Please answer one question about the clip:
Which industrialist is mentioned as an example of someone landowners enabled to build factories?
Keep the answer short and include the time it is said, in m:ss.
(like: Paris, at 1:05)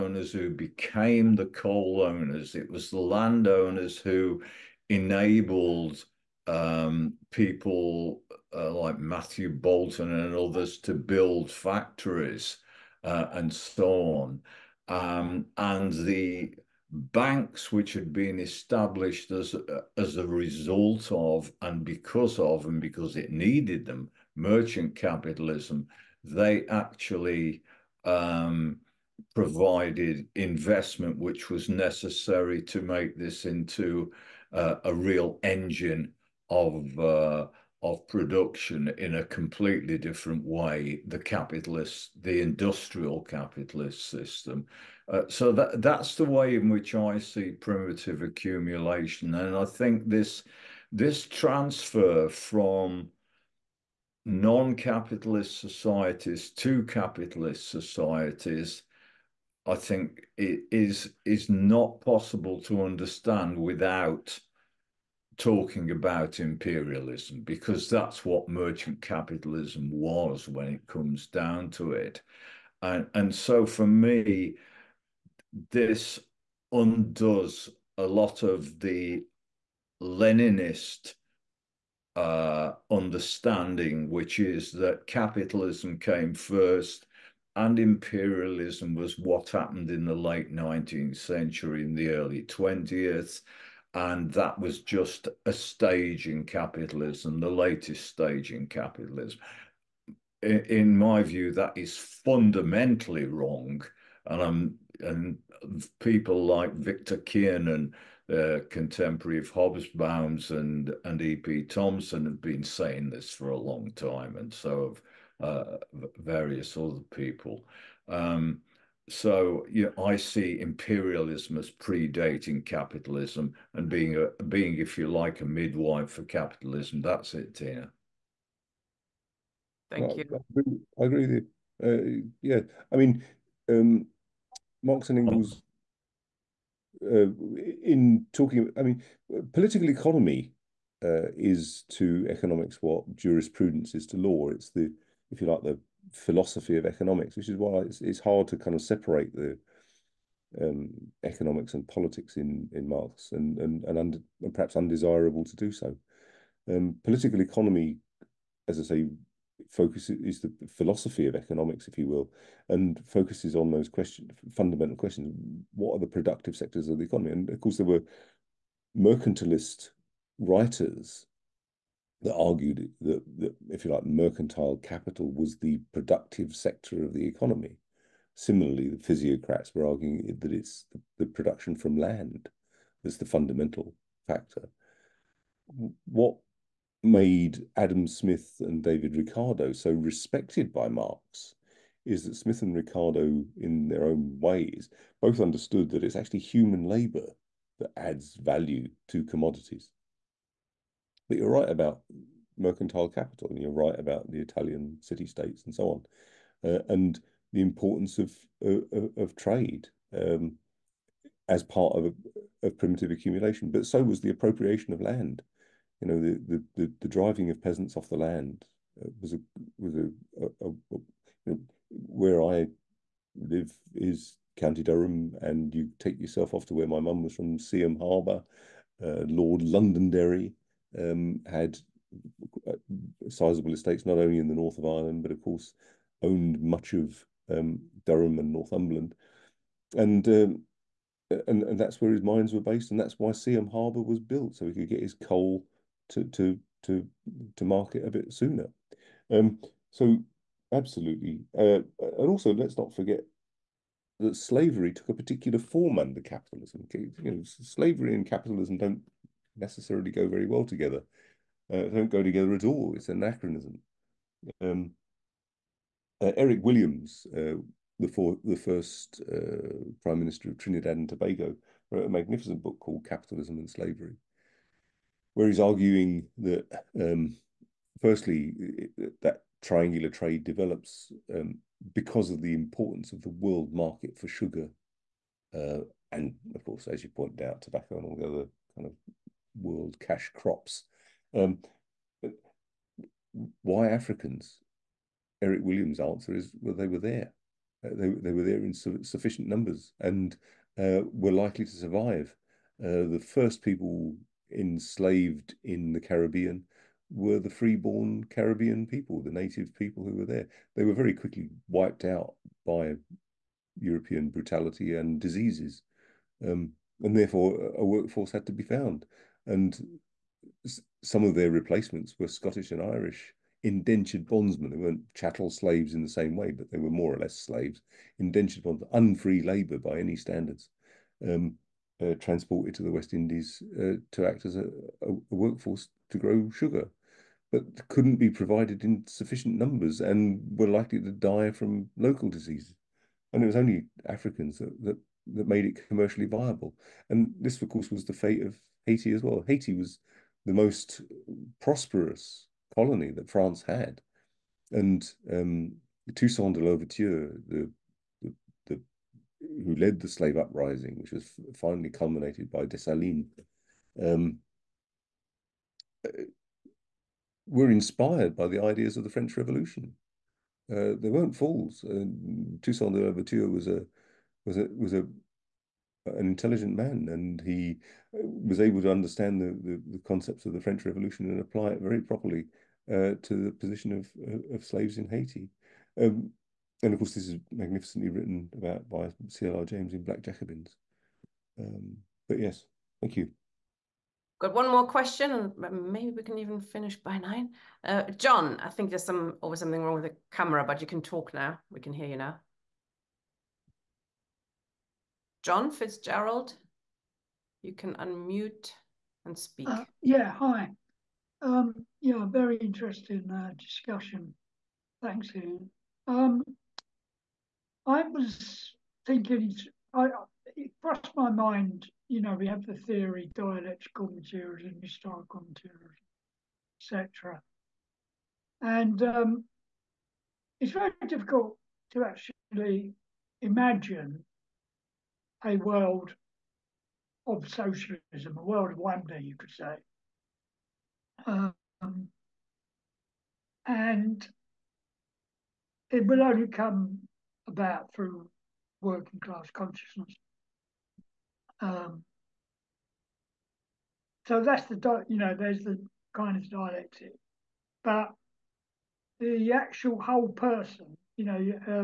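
Matthew Boulton, at 0:08.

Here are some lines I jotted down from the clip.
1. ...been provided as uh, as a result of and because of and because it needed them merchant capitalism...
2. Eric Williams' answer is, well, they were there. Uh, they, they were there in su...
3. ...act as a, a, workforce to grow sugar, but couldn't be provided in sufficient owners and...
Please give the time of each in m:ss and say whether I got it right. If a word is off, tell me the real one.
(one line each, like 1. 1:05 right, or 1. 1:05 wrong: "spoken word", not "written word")
1. 0:18 wrong: "established", not "provided"
2. 4:55 right
3. 5:34 wrong: "numbers", not "owners".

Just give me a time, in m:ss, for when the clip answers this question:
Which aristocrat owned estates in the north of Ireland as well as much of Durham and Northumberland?
3:49.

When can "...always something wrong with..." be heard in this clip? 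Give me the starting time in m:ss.
6:39.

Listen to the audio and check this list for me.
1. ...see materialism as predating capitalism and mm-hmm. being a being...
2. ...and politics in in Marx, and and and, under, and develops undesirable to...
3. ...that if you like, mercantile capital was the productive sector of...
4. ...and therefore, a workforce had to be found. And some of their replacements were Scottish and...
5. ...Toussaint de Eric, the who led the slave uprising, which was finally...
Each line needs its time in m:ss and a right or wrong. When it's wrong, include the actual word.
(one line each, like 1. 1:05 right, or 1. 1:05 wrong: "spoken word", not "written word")
1. 2:00 wrong: "imperialism", not "materialism"
2. 2:31 wrong: "perhaps", not "develops"
3. 2:53 right
4. 5:17 right
5. 5:56 wrong: "Louverture", not "Eric".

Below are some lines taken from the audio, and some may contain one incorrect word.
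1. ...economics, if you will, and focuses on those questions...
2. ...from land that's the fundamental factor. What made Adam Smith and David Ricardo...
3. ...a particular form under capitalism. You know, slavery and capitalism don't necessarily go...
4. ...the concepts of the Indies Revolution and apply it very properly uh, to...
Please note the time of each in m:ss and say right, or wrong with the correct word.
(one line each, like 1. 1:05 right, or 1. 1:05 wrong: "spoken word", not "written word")
1. 2:41 right
2. 3:01 right
3. 4:15 right
4. 6:19 wrong: "French", not "Indies".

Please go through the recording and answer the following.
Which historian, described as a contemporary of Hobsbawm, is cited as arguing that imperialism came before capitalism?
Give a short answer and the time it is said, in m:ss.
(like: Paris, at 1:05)
Victor Kiernan, at 1:46.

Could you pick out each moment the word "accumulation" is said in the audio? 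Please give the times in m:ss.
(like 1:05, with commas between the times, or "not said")
0:48, 3:33.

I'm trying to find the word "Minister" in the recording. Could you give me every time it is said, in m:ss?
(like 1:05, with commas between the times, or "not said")
4:30.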